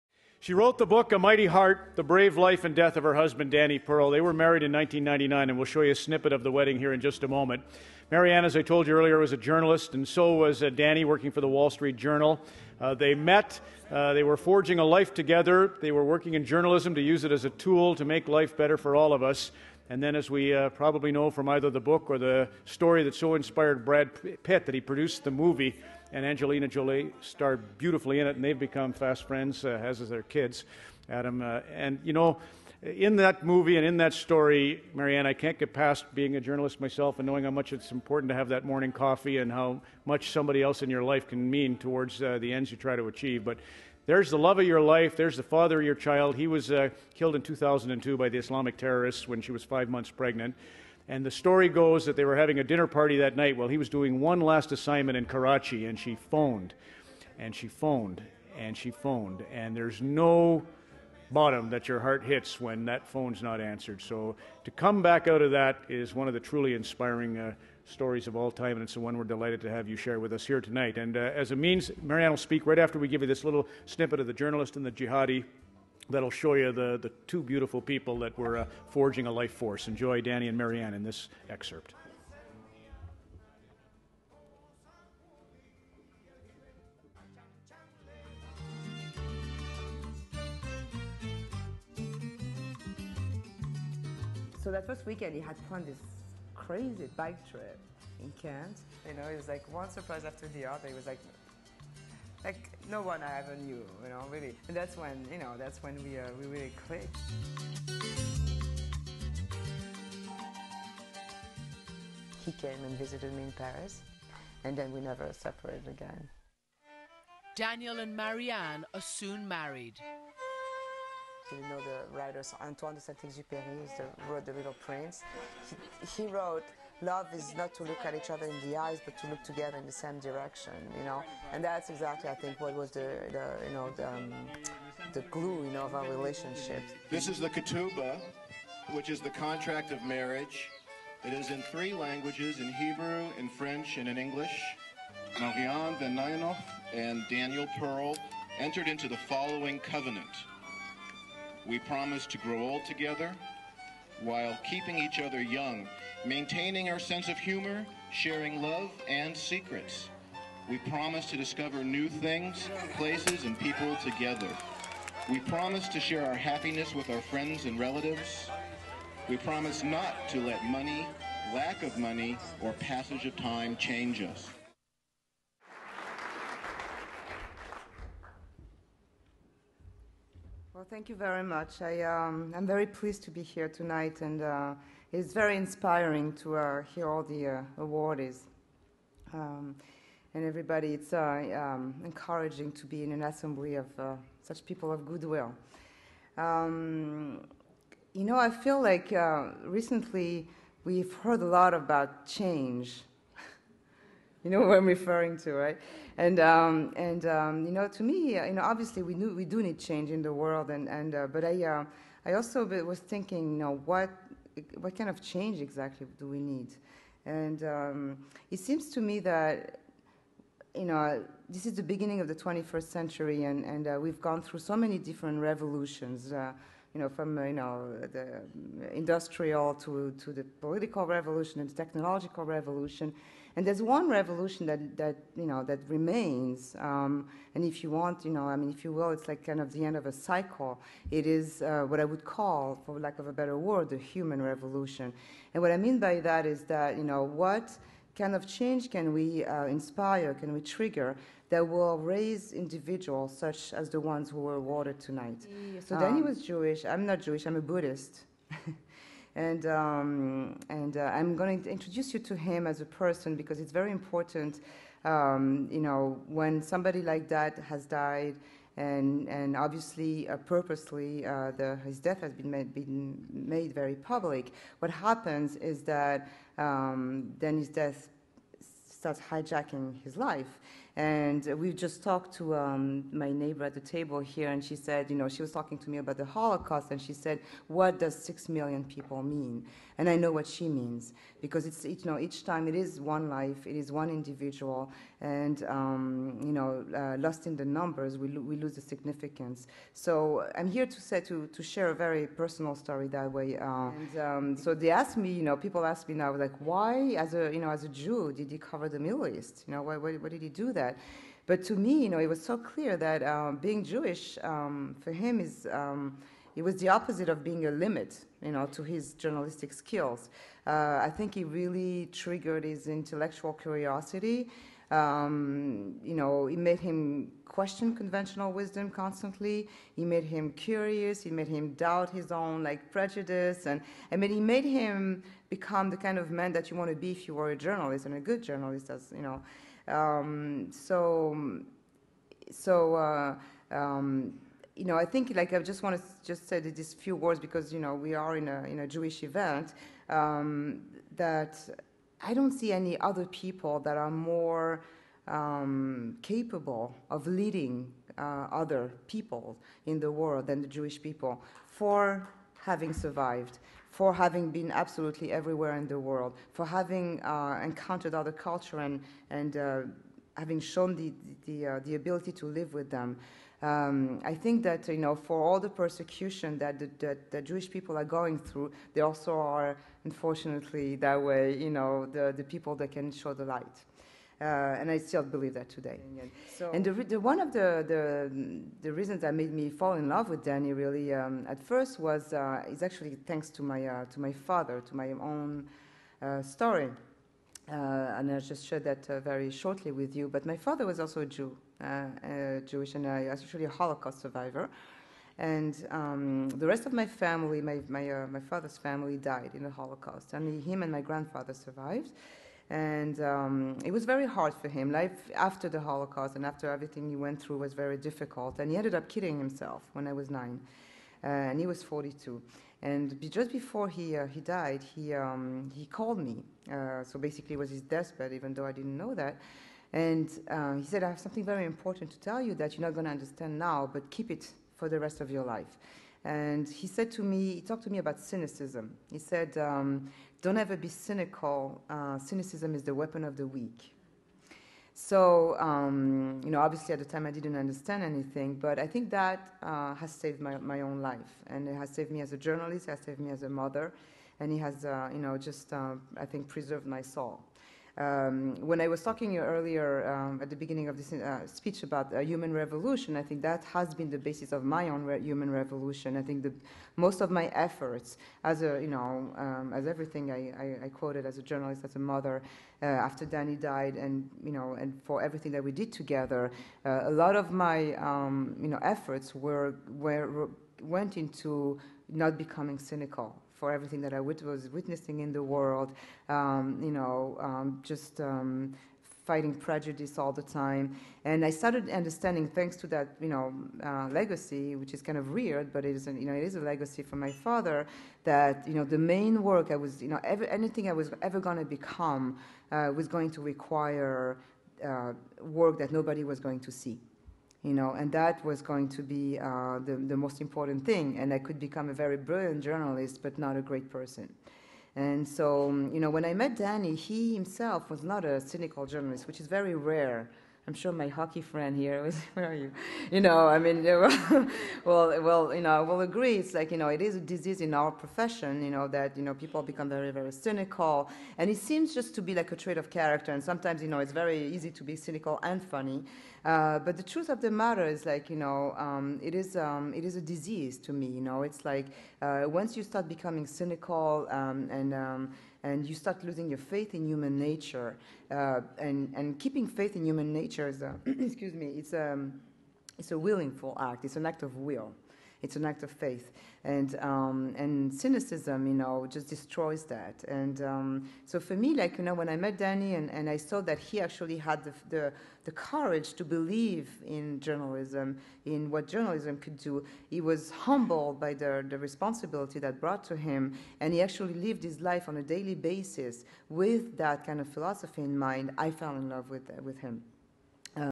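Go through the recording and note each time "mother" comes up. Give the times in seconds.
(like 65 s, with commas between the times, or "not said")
453 s, 471 s.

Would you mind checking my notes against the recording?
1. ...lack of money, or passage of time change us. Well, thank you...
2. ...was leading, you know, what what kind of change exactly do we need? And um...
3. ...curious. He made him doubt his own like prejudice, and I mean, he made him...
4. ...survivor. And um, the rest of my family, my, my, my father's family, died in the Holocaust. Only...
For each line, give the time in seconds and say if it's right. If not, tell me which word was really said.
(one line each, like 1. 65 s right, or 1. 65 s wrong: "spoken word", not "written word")
1. 171 s right
2. 212 s wrong: "thinking", not "leading"
3. 330 s right
4. 404 s right.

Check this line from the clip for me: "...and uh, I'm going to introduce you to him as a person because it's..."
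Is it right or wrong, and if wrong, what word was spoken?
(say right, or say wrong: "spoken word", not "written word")
right.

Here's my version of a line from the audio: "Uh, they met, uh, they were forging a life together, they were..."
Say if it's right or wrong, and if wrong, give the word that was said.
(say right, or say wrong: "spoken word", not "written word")
right.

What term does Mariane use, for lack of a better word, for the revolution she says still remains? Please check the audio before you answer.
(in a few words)
the human revolution.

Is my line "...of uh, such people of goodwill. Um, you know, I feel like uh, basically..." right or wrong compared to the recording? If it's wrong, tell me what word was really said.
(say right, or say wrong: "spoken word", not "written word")
wrong: "recently", not "basically".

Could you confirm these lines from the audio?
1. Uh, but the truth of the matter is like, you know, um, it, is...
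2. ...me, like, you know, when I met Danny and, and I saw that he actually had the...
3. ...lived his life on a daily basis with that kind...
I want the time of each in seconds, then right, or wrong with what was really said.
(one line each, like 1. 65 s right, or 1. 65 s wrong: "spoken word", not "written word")
1. 536 s right
2. 561 s right
3. 574 s right.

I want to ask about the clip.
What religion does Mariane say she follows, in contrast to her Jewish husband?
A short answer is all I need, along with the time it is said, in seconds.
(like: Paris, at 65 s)
Buddhist, at 257 s.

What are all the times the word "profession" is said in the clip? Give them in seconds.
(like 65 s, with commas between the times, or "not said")
527 s.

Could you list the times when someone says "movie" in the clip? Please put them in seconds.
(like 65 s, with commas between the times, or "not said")
25 s, 33 s.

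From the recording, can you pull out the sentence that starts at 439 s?
He said, um, Don't ever be cynical.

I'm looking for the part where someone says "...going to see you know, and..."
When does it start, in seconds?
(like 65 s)
506 s.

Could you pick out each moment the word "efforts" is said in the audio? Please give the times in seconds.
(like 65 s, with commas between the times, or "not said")
467 s, 478 s.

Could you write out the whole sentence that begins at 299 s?
So I'm here to say to to share a very personal story that way.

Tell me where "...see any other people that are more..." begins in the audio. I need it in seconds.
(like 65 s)
352 s.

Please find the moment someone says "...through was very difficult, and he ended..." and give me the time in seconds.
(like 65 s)
417 s.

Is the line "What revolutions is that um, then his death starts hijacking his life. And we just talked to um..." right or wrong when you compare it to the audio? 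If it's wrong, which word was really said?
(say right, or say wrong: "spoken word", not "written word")
wrong: "happens", not "revolutions".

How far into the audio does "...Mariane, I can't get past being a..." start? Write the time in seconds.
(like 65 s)
34 s.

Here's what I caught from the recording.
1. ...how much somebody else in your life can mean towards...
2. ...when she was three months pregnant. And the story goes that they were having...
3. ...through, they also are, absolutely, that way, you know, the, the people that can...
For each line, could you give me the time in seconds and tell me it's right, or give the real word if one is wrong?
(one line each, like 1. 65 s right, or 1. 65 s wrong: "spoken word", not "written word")
1. 39 s right
2. 49 s wrong: "five", not "three"
3. 378 s wrong: "unfortunately", not "absolutely".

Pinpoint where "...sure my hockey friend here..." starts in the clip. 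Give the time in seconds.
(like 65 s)
520 s.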